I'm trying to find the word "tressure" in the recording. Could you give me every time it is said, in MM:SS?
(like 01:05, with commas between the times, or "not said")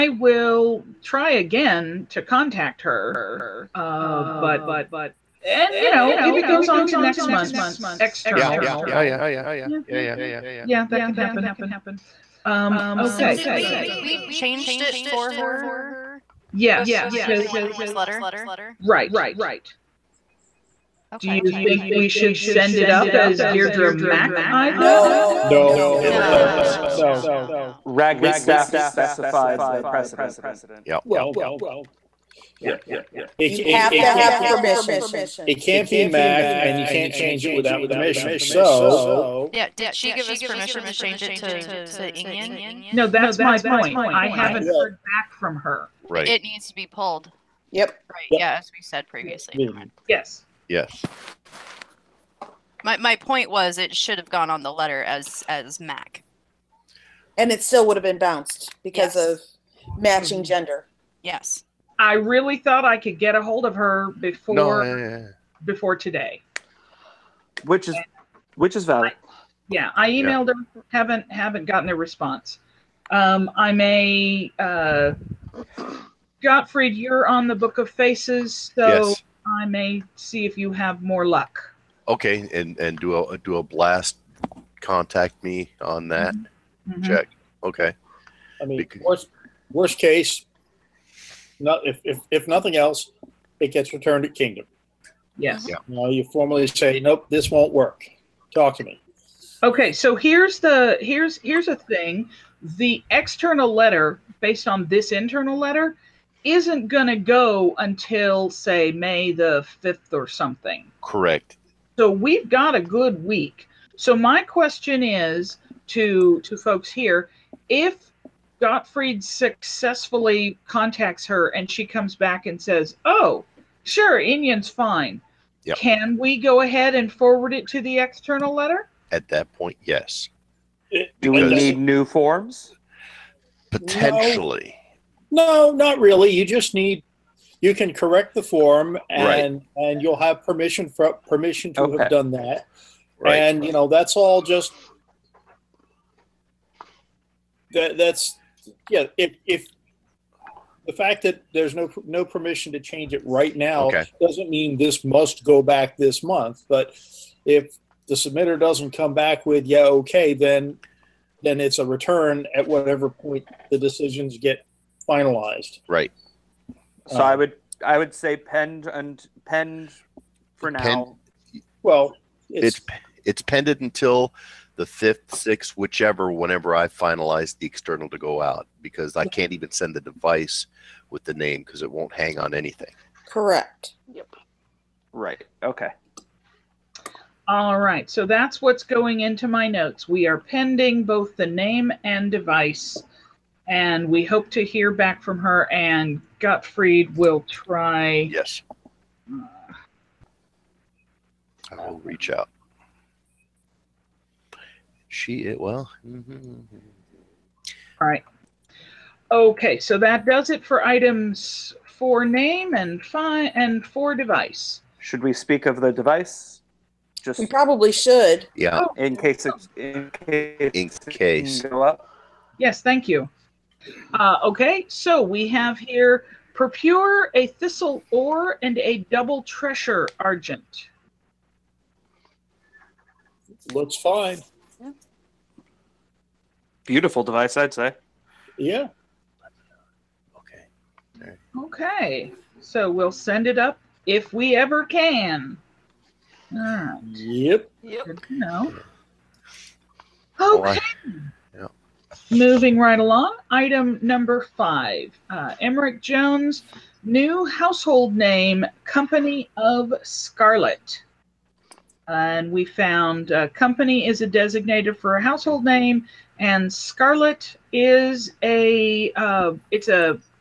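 03:49.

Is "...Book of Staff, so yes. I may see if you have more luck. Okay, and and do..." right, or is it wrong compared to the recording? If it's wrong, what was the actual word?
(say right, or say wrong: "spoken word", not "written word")
wrong: "Faces", not "Staff".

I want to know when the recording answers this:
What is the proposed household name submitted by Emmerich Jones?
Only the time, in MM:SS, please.
04:18.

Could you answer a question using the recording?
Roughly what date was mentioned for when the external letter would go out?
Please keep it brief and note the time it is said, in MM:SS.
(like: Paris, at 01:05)
May 5th, at 01:48.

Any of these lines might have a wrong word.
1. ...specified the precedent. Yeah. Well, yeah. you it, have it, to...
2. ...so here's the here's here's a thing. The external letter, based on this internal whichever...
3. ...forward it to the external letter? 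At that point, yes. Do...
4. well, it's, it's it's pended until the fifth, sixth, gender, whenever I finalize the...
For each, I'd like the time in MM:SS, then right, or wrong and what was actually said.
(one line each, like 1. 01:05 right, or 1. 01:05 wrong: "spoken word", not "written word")
1. 00:28 right
2. 01:39 wrong: "letter", not "whichever"
3. 02:07 right
4. 02:51 wrong: "whichever", not "gender".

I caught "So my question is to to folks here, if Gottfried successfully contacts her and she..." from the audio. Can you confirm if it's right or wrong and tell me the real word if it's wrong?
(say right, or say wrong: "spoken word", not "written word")
right.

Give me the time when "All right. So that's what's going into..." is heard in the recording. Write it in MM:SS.
03:07.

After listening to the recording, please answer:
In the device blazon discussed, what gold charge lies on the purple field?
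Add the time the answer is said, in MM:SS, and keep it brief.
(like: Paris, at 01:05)
a thistle, at 03:47.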